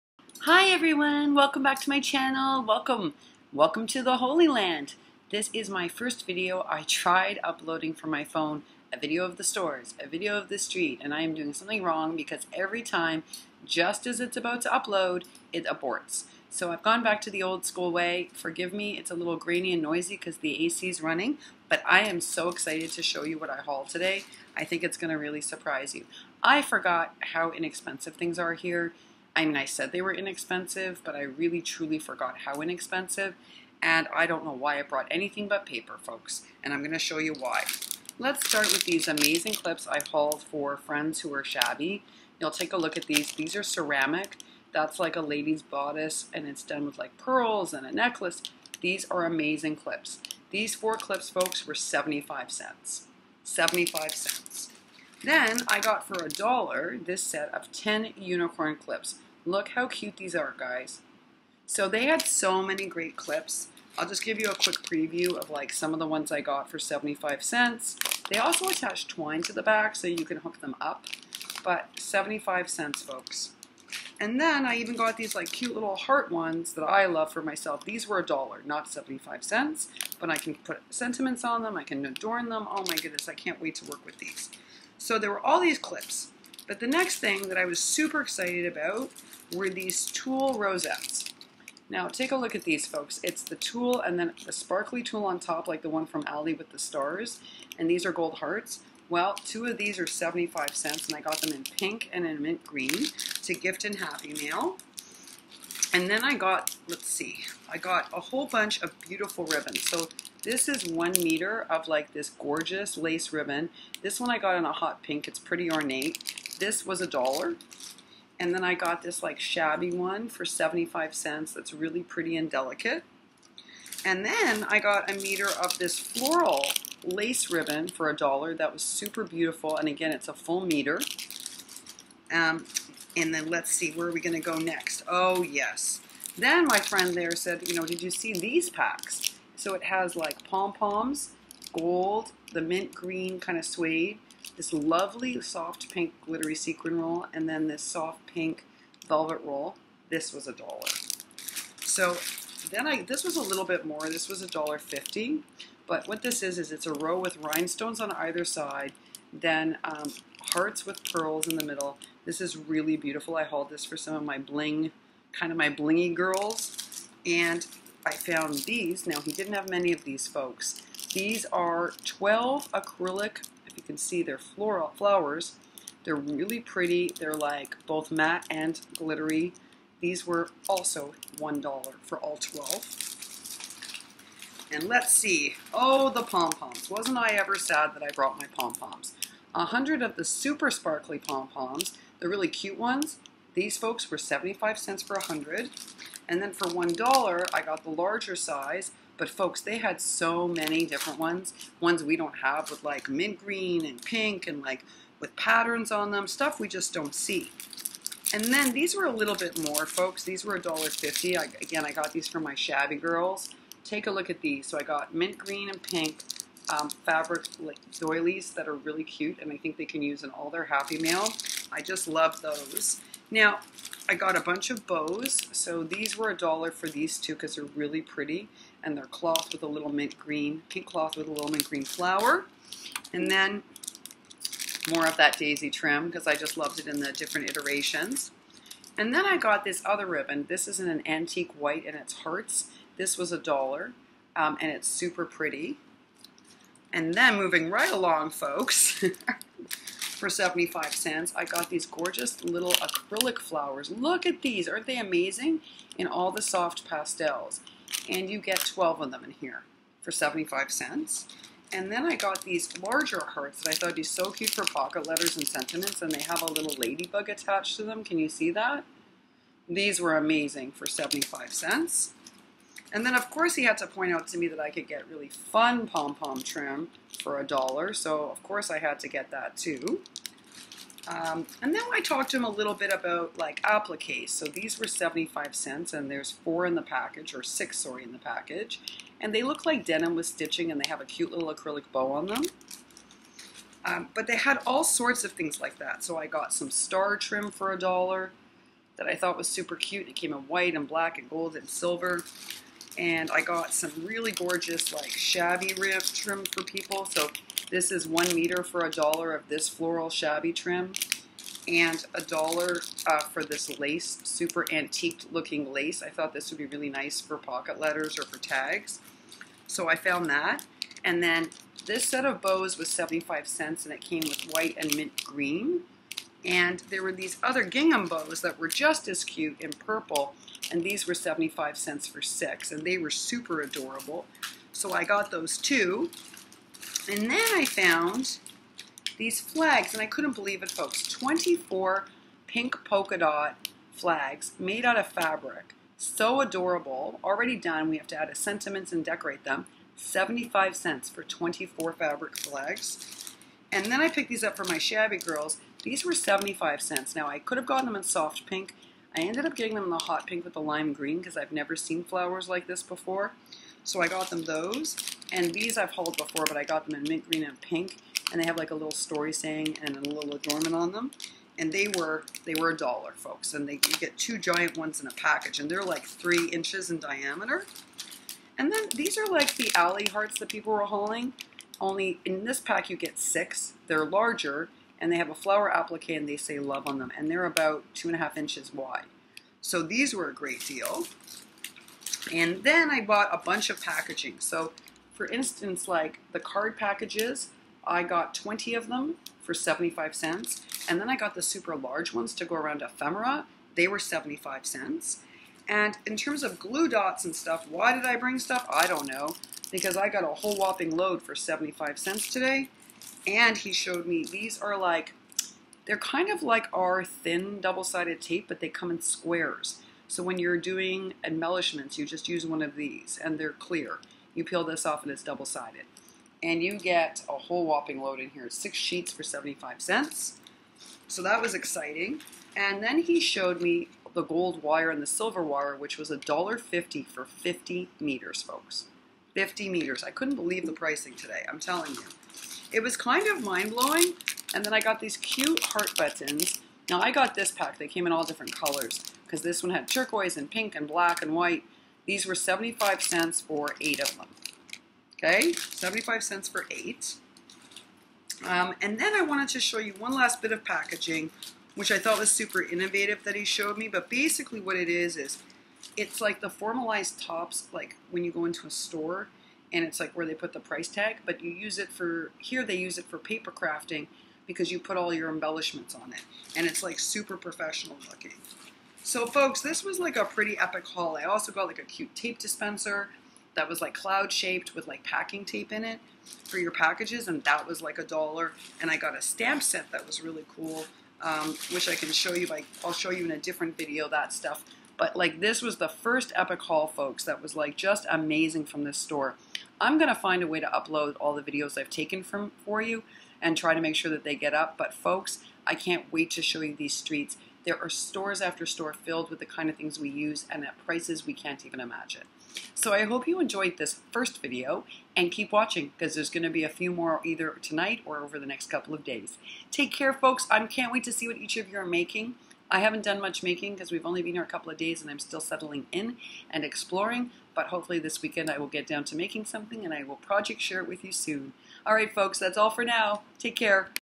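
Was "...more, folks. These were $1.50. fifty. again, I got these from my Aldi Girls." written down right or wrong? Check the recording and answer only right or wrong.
wrong.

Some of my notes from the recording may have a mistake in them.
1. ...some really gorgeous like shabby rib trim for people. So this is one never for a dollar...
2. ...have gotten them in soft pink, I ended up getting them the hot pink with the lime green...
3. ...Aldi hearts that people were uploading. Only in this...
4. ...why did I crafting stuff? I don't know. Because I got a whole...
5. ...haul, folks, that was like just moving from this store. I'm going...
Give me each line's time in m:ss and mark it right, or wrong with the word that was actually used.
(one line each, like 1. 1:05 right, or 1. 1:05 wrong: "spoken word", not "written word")
1. 5:03 wrong: "meter", not "never"
2. 5:57 right
3. 6:19 wrong: "hauling", not "uploading"
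4. 6:47 wrong: "bring", not "crafting"
5. 8:16 wrong: "amazing", not "moving".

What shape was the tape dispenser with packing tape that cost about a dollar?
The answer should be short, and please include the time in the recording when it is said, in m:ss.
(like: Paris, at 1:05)
Cloud, at 8:03.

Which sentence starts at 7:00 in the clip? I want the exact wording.
So when you're doing embellishments, you just use one of these and they're clear.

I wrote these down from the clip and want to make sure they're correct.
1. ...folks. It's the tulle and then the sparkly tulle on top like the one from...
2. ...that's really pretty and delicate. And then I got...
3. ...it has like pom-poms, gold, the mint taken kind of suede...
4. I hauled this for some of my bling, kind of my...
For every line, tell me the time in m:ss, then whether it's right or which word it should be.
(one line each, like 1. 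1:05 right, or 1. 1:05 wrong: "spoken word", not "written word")
1. 1:32 right
2. 2:01 right
3. 2:19 wrong: "green", not "taken"
4. 2:43 right.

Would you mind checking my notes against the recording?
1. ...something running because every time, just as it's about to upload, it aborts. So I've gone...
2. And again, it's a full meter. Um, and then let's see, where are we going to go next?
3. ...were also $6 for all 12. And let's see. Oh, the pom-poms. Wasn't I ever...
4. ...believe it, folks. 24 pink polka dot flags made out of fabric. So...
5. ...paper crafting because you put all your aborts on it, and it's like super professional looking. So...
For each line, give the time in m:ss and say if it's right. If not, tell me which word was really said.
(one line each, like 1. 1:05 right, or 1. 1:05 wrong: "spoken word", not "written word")
1. 0:11 wrong: "wrong", not "running"
2. 2:09 right
3. 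3:00 wrong: "1", not "6"
4. 5:40 right
5. 7:53 wrong: "embellishments", not "aborts".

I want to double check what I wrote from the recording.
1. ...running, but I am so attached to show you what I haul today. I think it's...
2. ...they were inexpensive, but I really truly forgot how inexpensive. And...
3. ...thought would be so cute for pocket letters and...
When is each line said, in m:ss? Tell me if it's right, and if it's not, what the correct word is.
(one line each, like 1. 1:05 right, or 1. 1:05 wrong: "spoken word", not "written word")
1. 0:21 wrong: "excited", not "attached"
2. 0:29 right
3. 4:23 right.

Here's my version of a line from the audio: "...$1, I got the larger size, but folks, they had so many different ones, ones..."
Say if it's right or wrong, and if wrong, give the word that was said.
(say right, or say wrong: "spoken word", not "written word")
right.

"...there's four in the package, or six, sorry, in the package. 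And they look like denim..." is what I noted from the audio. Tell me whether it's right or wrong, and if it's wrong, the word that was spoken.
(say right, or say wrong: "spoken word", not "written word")
right.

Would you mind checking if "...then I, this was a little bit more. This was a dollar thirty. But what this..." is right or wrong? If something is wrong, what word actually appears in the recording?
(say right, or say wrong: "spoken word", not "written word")
wrong: "fifty", not "thirty".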